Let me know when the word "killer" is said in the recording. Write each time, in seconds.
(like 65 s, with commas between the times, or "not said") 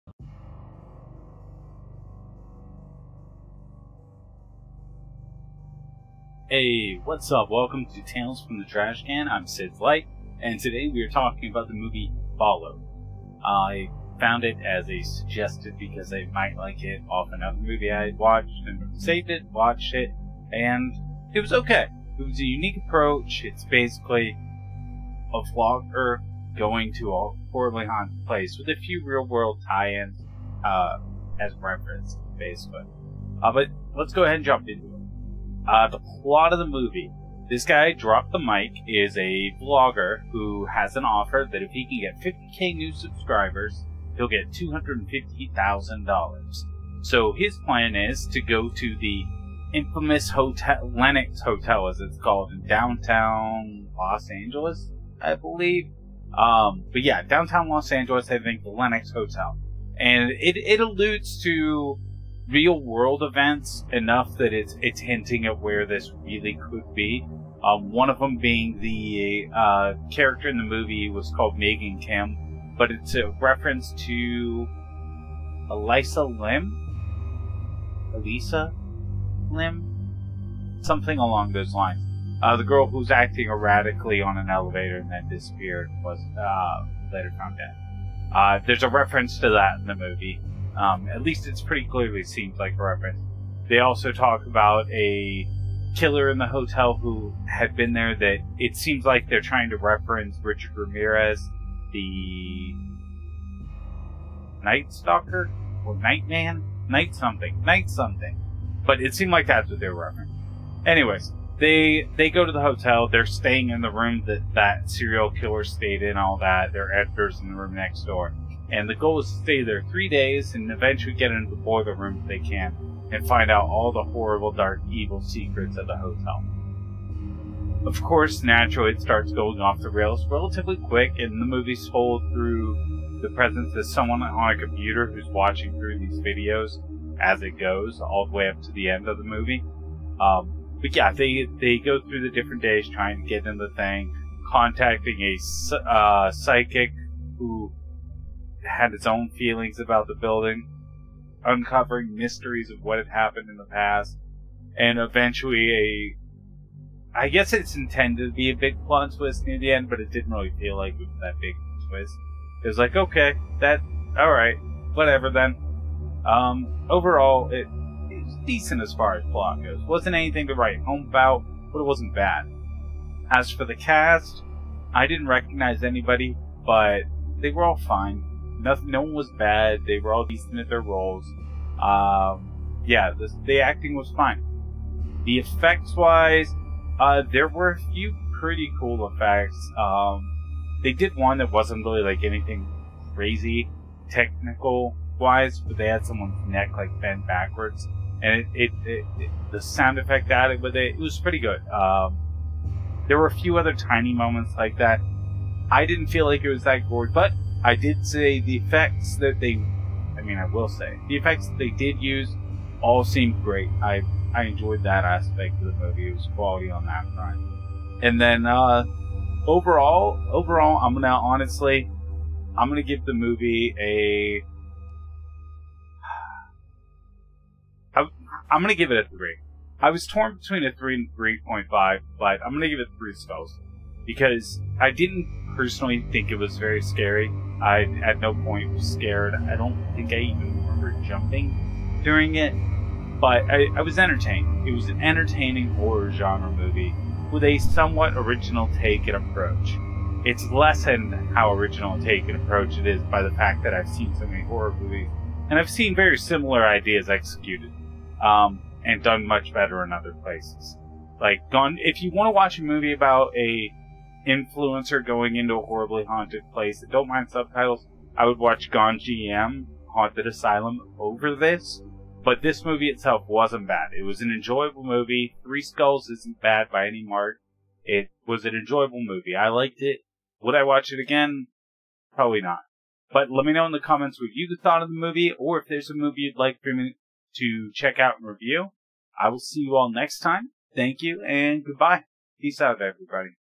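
95 s, 115 s.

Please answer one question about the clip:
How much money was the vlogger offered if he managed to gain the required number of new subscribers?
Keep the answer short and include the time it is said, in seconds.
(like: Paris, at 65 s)
$250,000, at 44 s.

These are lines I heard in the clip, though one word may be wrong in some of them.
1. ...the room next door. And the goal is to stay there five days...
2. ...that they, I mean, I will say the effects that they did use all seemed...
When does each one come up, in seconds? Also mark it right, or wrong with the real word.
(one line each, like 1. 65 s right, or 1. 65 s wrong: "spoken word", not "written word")
1. 117 s wrong: "three", not "five"
2. 209 s right.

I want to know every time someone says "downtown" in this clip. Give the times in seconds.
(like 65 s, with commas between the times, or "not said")
52 s, 57 s.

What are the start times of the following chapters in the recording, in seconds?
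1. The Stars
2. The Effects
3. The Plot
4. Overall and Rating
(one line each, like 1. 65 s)
1. 174 s
2. 186 s
3. 34 s
4. 219 s.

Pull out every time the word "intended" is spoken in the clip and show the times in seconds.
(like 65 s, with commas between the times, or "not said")
157 s.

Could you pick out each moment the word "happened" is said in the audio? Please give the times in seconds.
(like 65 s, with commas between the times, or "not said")
153 s.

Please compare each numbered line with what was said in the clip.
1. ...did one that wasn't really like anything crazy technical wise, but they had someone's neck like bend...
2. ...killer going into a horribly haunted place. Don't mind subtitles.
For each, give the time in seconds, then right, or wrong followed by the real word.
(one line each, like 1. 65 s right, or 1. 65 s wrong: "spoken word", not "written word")
1. 190 s right
2. 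264 s wrong: "influencer", not "killer".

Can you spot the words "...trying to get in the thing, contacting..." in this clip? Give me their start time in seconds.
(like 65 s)
142 s.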